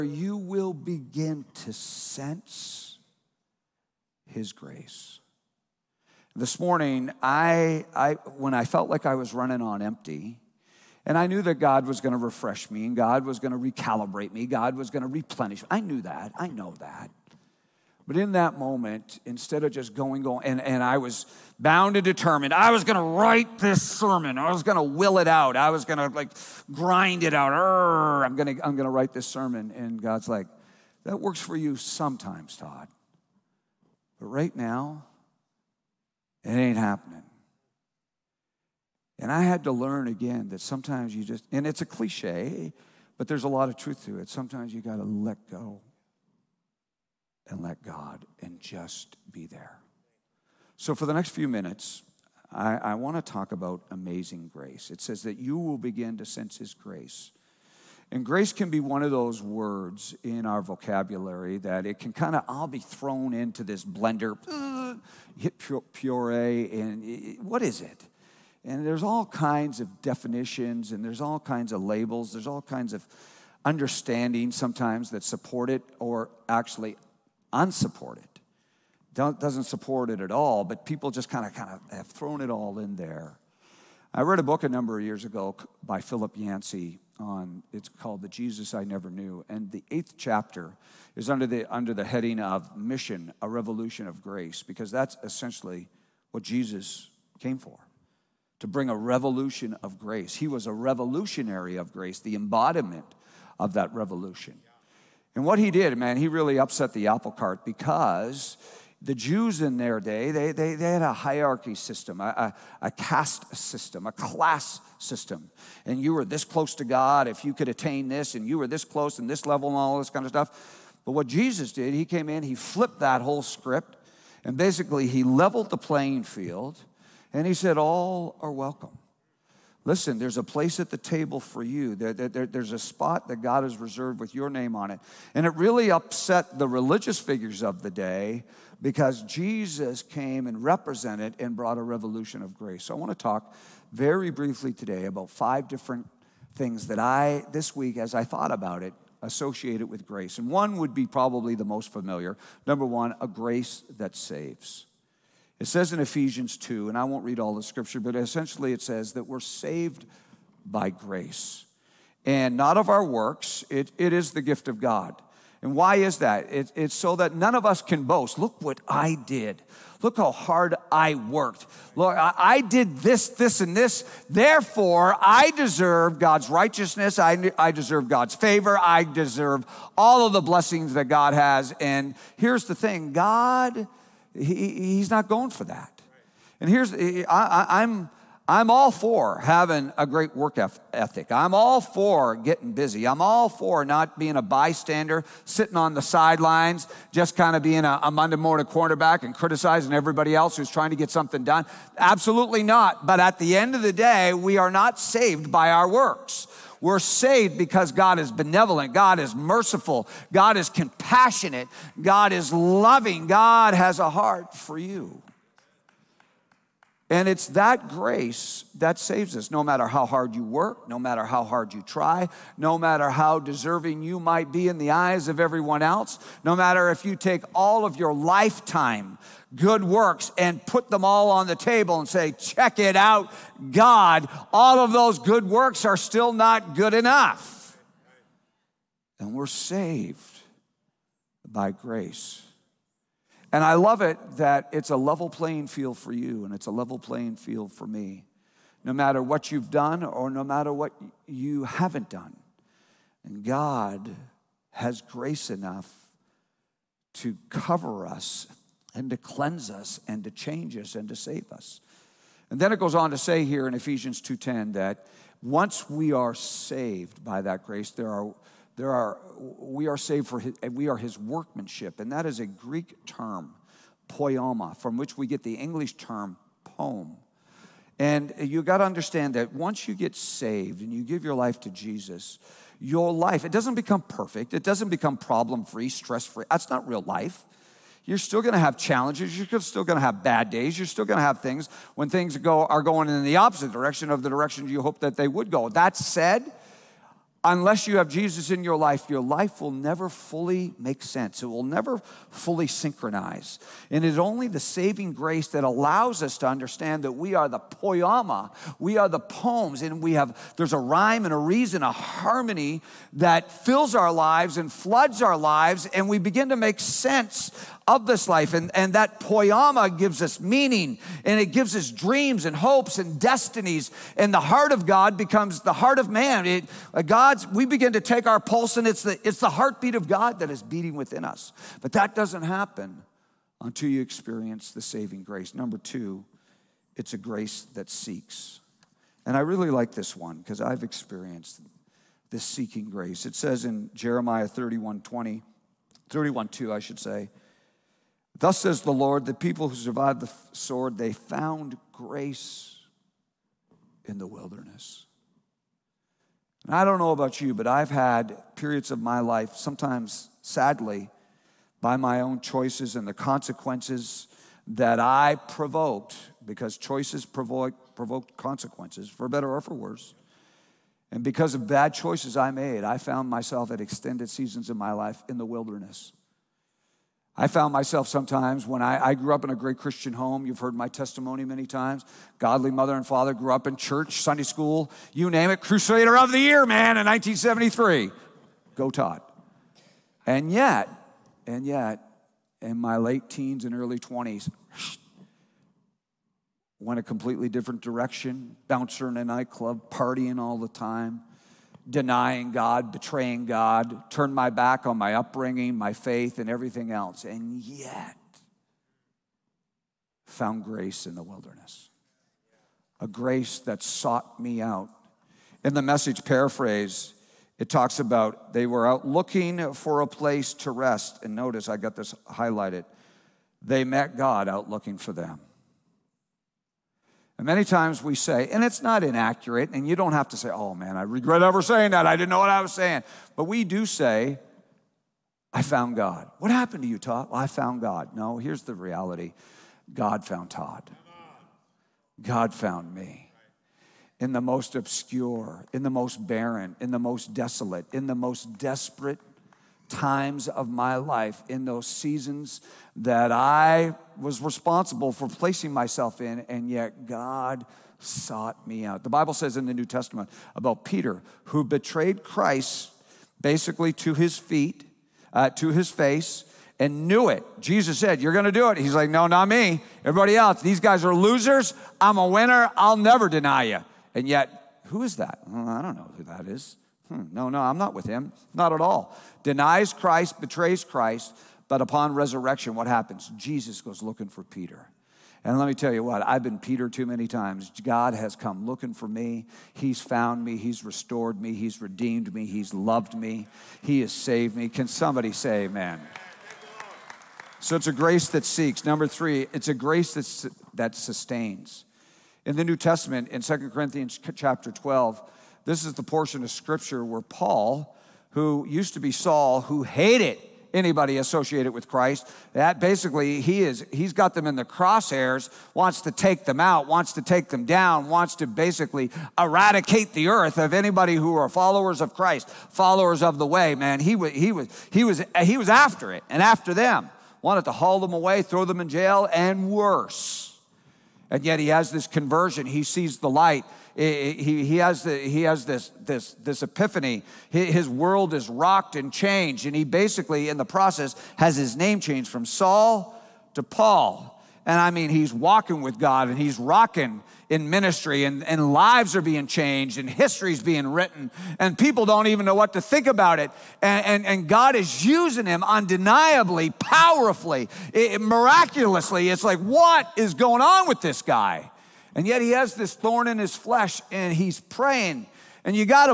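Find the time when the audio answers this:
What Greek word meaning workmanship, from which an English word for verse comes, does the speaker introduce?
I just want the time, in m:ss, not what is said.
4:34.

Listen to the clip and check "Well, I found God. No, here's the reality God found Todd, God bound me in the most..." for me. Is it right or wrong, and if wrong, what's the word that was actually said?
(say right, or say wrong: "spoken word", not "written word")
wrong: "found", not "bound".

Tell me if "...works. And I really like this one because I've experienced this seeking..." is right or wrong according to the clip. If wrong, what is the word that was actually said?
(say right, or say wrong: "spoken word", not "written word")
wrong: "seeks", not "works".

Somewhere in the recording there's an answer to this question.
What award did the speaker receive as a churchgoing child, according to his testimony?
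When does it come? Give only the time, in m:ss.
6:25.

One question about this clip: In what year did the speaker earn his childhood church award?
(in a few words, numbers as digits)
1973.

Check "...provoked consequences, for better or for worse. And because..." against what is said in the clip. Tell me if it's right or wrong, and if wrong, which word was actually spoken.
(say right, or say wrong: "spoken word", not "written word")
right.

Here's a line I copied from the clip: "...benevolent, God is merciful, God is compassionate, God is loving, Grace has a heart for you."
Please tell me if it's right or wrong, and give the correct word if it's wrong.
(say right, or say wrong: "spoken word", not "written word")
wrong: "God", not "Grace".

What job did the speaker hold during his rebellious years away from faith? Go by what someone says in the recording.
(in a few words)
bouncer in a nightclub.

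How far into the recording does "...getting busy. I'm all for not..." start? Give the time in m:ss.
3:12.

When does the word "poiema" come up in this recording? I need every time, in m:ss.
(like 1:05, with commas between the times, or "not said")
5:07, 5:19.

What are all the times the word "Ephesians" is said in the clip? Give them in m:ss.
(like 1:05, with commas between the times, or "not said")
2:35, 4:23.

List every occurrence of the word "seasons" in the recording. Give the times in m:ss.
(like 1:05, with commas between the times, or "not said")
6:14, 7:31.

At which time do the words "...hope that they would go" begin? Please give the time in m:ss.
4:54.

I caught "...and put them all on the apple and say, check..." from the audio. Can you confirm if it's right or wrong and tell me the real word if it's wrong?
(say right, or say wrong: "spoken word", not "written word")
wrong: "table", not "apple".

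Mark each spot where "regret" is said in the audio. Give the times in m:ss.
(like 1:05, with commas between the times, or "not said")
7:11.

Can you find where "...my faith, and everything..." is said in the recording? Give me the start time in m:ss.
6:45.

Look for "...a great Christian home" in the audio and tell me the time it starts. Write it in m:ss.
6:19.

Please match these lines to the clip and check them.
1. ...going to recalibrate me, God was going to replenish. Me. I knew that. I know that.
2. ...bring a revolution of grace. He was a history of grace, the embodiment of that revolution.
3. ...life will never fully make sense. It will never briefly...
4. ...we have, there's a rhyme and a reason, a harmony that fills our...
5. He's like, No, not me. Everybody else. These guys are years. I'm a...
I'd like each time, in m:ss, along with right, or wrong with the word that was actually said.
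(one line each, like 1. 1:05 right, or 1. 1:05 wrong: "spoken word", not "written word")
1. 0:13 right
2. 1:38 wrong: "revolutionary", not "history"
3. 4:59 wrong: "fully", not "briefly"
4. 5:10 right
5. 7:48 wrong: "losers", not "years".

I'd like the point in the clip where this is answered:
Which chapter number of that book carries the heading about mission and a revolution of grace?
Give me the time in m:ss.
1:29.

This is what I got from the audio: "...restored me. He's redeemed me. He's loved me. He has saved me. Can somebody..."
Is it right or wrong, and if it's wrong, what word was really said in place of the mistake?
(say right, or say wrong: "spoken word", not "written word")
right.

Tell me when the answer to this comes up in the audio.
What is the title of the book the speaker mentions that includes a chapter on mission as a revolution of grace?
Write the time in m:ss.
1:28.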